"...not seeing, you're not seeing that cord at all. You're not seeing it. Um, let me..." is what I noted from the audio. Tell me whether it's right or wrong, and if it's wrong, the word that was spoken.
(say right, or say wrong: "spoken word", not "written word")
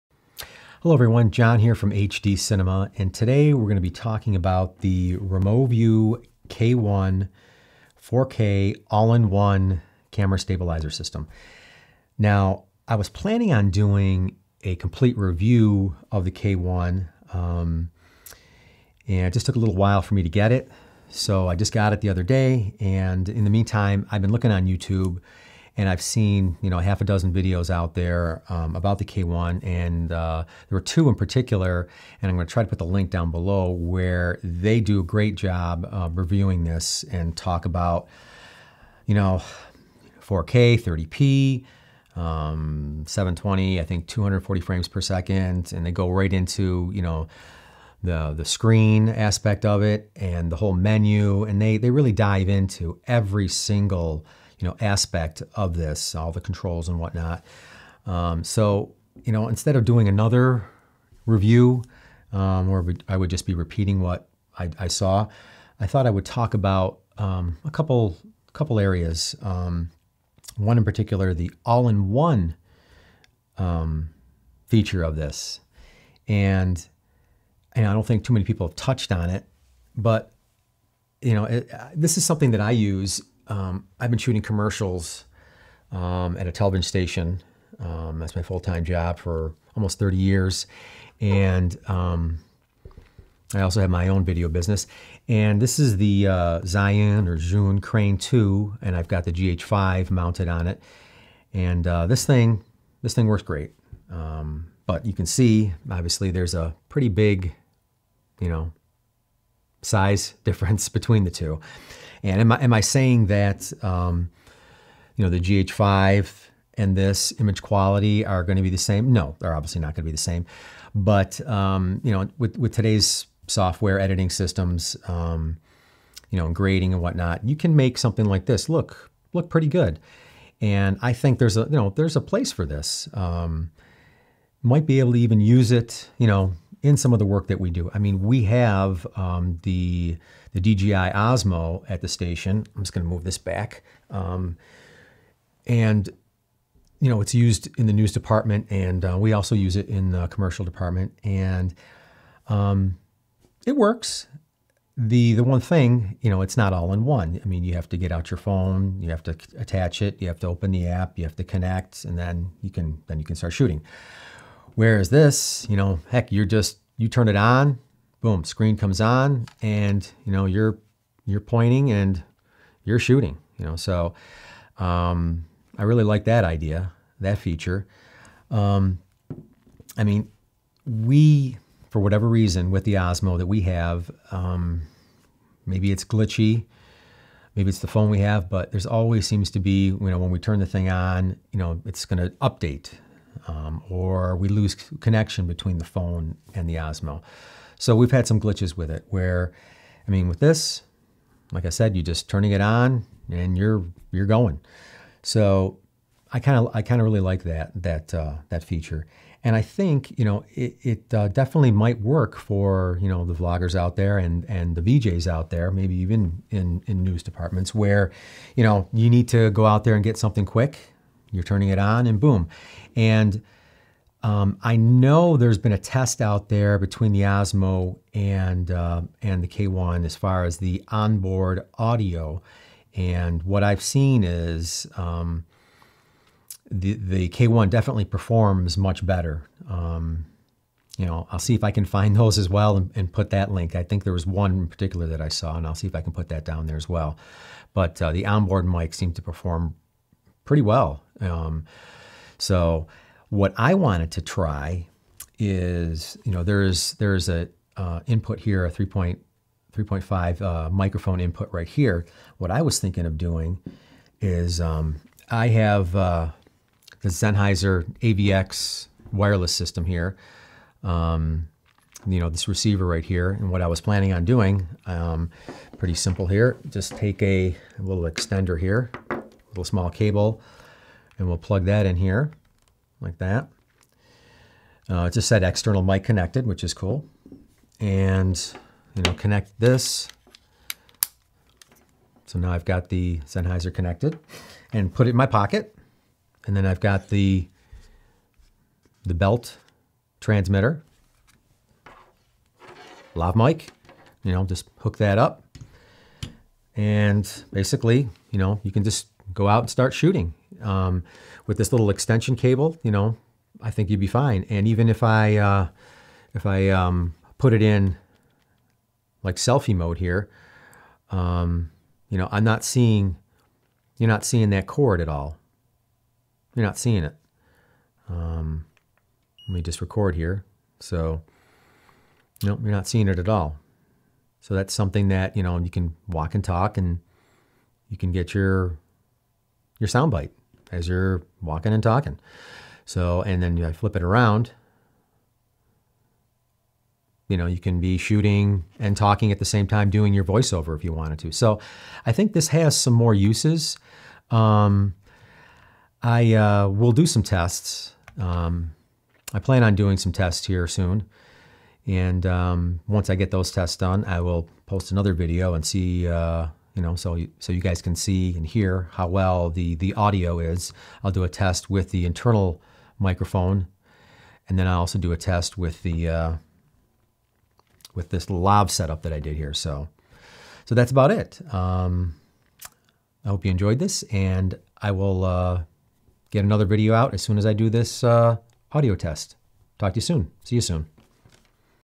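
right.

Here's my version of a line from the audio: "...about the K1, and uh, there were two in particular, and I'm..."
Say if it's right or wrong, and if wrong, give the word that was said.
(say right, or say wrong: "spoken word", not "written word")
right.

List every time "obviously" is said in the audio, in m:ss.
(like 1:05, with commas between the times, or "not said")
1:45, 1:59.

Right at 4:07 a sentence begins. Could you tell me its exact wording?
But uh, the onboard mic seemed to perform pretty well.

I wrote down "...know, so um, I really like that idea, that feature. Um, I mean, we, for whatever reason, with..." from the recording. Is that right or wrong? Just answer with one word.
right.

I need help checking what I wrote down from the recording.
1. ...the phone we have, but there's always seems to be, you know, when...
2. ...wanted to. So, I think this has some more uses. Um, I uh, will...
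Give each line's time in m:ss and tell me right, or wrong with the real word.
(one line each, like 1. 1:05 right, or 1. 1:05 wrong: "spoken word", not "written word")
1. 3:07 right
2. 5:50 right.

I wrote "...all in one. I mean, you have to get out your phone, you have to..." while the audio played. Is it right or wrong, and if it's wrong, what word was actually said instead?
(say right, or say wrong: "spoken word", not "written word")
right.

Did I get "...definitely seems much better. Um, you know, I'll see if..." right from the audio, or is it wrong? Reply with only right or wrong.
wrong.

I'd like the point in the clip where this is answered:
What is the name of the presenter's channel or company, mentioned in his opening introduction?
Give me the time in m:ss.
0:01.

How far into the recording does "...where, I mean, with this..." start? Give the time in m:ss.
3:19.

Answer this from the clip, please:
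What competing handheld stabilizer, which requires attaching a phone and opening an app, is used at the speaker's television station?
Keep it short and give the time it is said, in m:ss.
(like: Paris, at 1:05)
DJI Osmo, at 2:20.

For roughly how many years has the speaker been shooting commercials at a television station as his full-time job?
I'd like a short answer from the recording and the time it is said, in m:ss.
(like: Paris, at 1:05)
30, at 1:29.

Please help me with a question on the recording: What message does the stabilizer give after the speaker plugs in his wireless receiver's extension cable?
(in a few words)
external mic connected.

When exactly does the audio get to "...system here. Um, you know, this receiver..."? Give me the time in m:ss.
4:29.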